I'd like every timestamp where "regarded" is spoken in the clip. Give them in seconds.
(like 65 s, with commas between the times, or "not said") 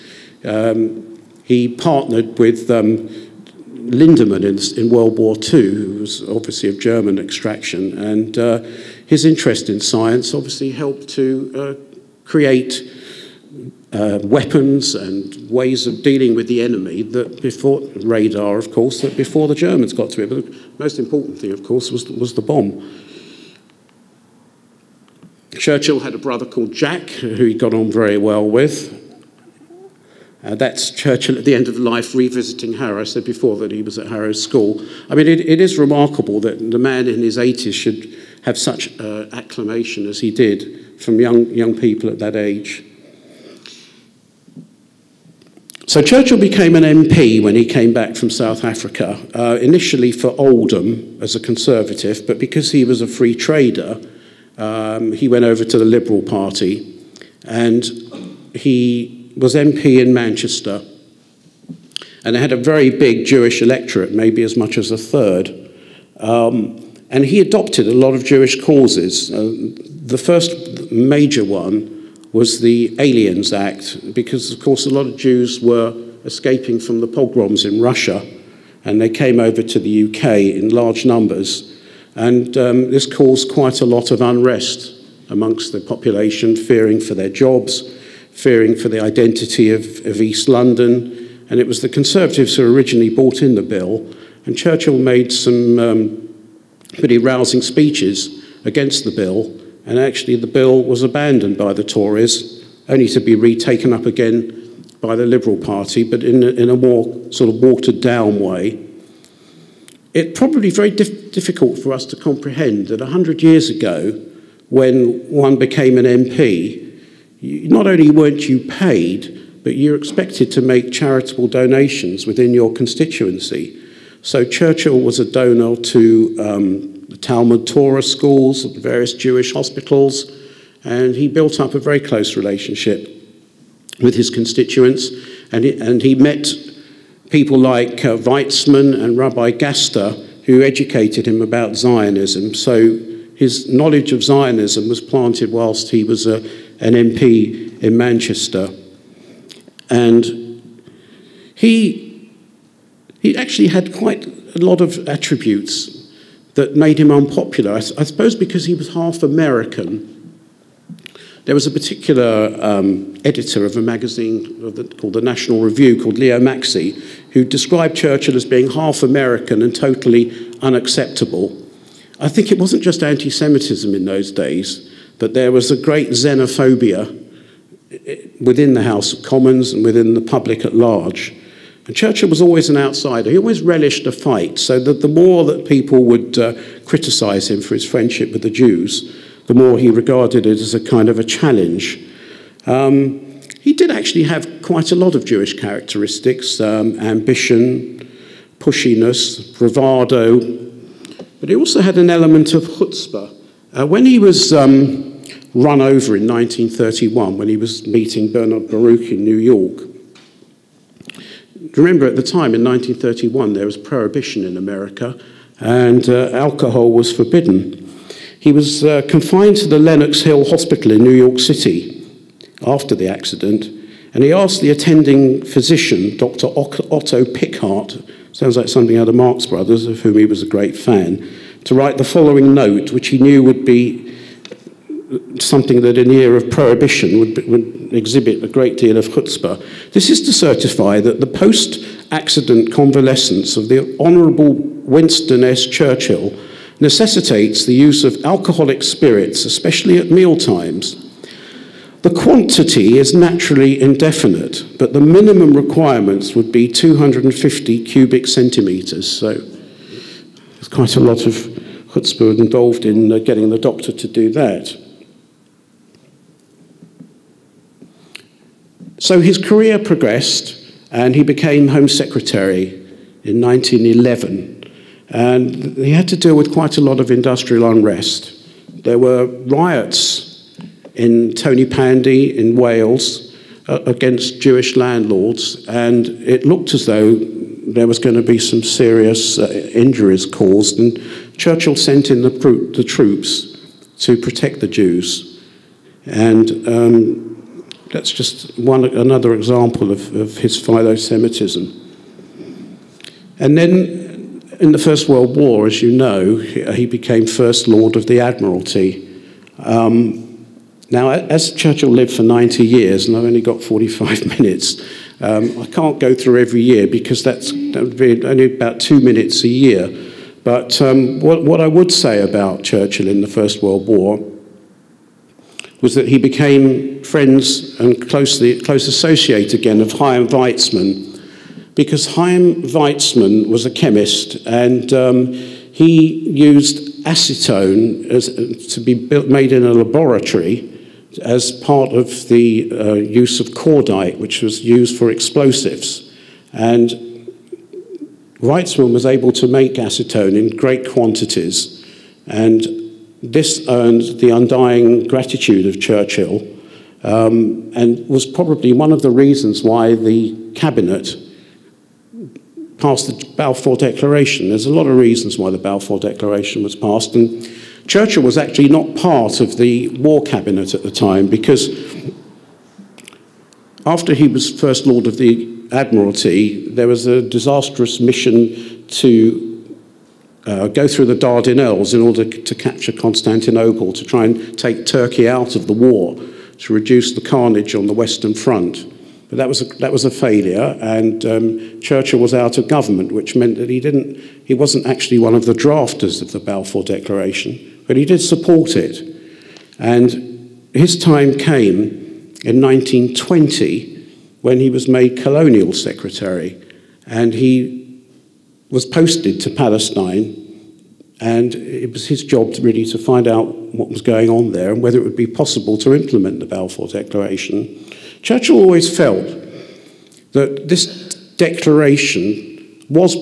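189 s.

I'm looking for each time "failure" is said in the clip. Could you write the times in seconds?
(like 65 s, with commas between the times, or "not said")
390 s.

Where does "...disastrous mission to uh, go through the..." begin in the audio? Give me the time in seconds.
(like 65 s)
377 s.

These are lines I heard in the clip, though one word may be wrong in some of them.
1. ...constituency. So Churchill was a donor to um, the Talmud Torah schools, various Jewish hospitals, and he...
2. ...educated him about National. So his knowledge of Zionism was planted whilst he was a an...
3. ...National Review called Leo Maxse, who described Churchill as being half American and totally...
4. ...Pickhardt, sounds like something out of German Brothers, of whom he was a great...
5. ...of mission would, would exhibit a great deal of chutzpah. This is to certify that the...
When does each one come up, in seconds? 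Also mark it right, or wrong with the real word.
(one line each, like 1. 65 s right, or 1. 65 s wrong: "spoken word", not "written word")
1. 122 s right
2. 140 s wrong: "Zionism", not "National"
3. 165 s right
4. 227 s wrong: "Marx", not "German"
5. 236 s wrong: "prohibition", not "mission".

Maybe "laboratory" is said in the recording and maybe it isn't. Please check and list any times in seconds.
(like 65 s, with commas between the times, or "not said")
339 s.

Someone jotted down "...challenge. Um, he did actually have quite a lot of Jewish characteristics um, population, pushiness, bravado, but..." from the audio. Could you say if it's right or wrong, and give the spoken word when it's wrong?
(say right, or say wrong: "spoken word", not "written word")
wrong: "ambition", not "population".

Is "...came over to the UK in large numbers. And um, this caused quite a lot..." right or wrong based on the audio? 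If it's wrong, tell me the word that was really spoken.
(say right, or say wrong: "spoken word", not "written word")
right.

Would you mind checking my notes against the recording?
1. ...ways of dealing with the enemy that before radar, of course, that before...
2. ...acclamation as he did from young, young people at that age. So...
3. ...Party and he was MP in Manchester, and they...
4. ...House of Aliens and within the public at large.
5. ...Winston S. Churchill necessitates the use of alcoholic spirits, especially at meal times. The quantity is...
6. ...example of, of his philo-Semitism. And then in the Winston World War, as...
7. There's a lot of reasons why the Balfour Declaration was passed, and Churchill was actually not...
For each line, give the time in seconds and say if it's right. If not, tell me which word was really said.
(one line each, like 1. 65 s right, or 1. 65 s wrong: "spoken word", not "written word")
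1. 15 s right
2. 39 s right
3. 56 s right
4. 178 s wrong: "Commons", not "Aliens"
5. 244 s right
6. 299 s wrong: "First", not "Winston"
7. 364 s right.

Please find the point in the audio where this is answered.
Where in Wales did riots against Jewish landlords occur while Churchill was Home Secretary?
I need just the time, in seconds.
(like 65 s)
281 s.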